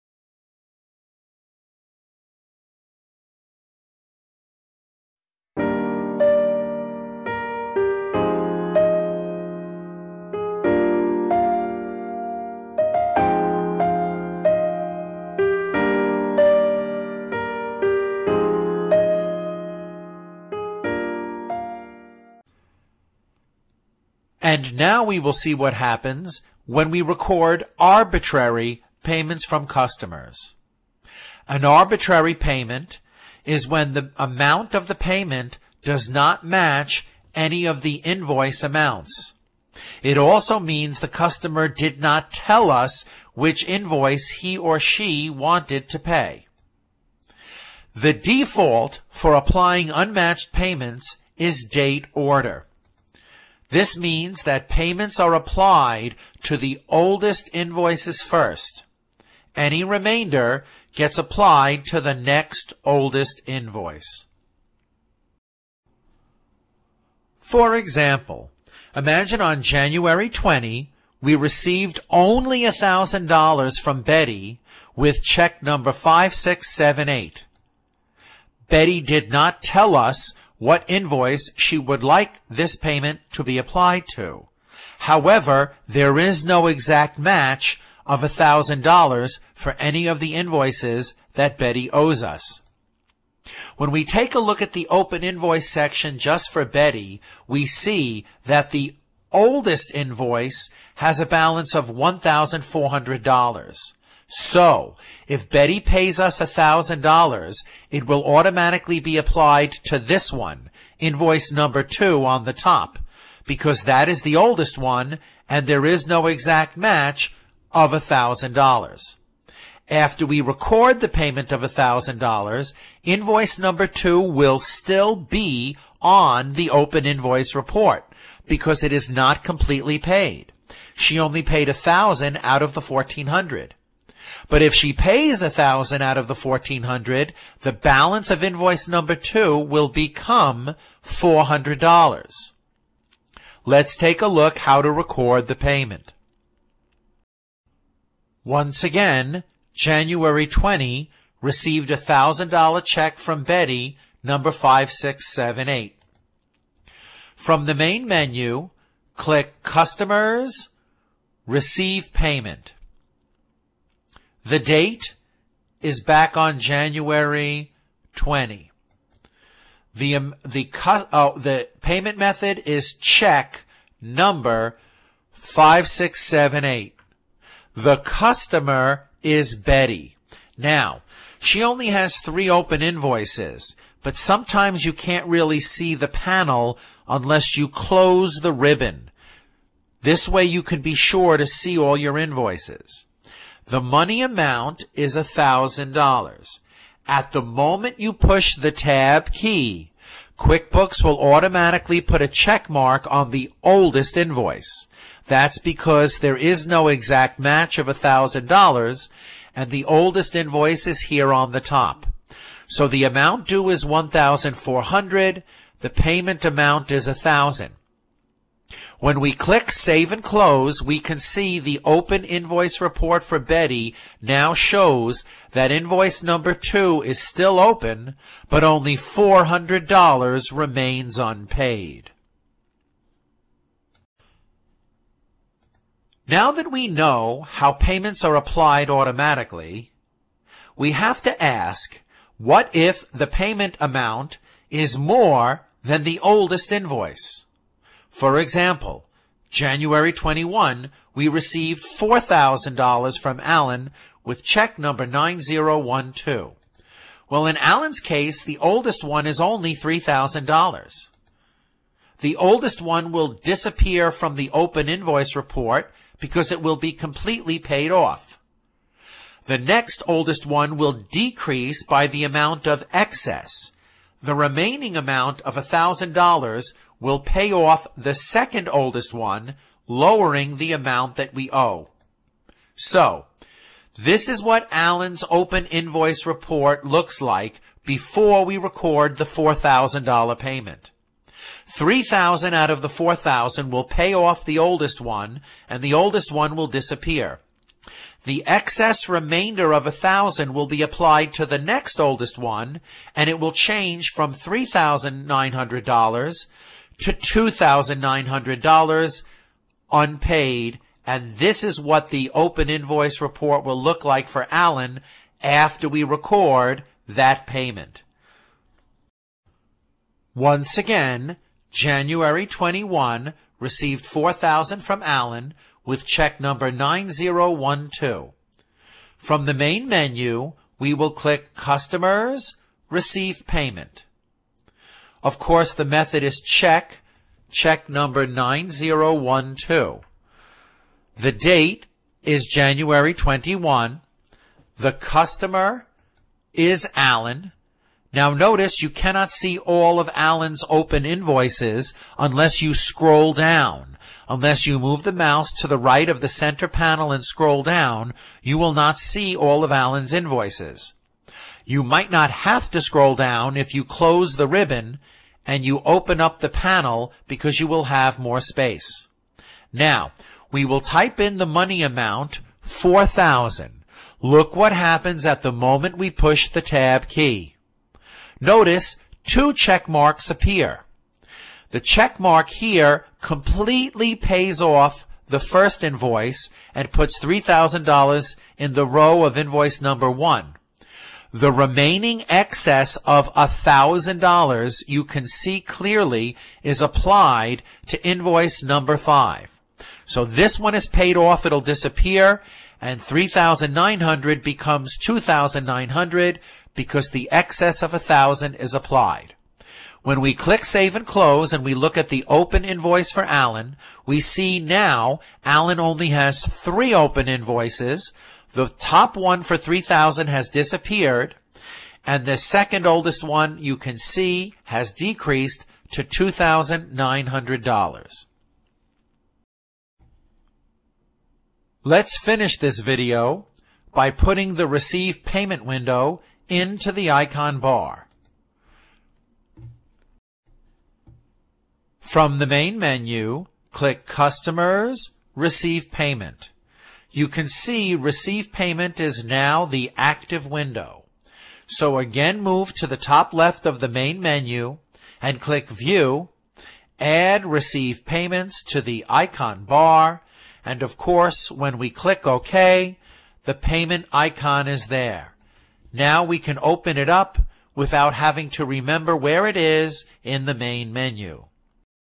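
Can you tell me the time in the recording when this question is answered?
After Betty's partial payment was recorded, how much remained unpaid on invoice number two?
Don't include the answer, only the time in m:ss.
2:21.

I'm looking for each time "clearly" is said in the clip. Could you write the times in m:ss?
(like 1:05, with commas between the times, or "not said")
6:35.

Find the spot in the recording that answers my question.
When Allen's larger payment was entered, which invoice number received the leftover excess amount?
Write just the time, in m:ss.
6:38.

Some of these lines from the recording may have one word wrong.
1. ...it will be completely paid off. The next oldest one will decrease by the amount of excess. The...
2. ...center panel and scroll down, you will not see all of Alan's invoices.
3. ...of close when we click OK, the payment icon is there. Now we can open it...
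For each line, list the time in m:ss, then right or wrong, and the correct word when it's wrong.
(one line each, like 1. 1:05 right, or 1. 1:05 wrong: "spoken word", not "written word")
1. 4:26 right
2. 5:56 right
3. 7:40 wrong: "course", not "close".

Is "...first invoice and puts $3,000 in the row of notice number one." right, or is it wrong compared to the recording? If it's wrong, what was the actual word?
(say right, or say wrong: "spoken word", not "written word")
wrong: "invoice", not "notice".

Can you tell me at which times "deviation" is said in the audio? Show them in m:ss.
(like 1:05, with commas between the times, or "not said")
not said.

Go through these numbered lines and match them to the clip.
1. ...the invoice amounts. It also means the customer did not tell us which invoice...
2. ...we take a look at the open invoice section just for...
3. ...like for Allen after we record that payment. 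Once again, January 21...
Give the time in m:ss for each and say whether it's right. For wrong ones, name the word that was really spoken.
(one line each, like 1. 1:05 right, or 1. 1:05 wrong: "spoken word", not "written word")
1. 0:37 right
2. 1:33 right
3. 5:14 right.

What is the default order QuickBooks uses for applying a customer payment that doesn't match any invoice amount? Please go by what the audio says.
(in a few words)
Date order.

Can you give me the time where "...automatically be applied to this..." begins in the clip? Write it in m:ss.
1:48.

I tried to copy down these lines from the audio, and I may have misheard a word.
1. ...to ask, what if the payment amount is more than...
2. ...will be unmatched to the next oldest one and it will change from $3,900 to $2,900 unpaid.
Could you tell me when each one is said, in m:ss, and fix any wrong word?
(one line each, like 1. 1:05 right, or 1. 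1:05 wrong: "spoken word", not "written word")
1. 4:01 right
2. 5:00 wrong: "applied", not "unmatched".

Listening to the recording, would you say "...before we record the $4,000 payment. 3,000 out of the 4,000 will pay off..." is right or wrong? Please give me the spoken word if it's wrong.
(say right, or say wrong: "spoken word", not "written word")
right.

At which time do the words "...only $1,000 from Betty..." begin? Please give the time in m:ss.
1:12.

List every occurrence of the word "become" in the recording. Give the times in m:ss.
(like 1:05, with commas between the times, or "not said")
2:19, 6:44.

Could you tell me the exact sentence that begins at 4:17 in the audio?
Well, in Allen's case, the oldest one is only $3,000.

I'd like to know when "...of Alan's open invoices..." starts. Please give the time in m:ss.
5:49.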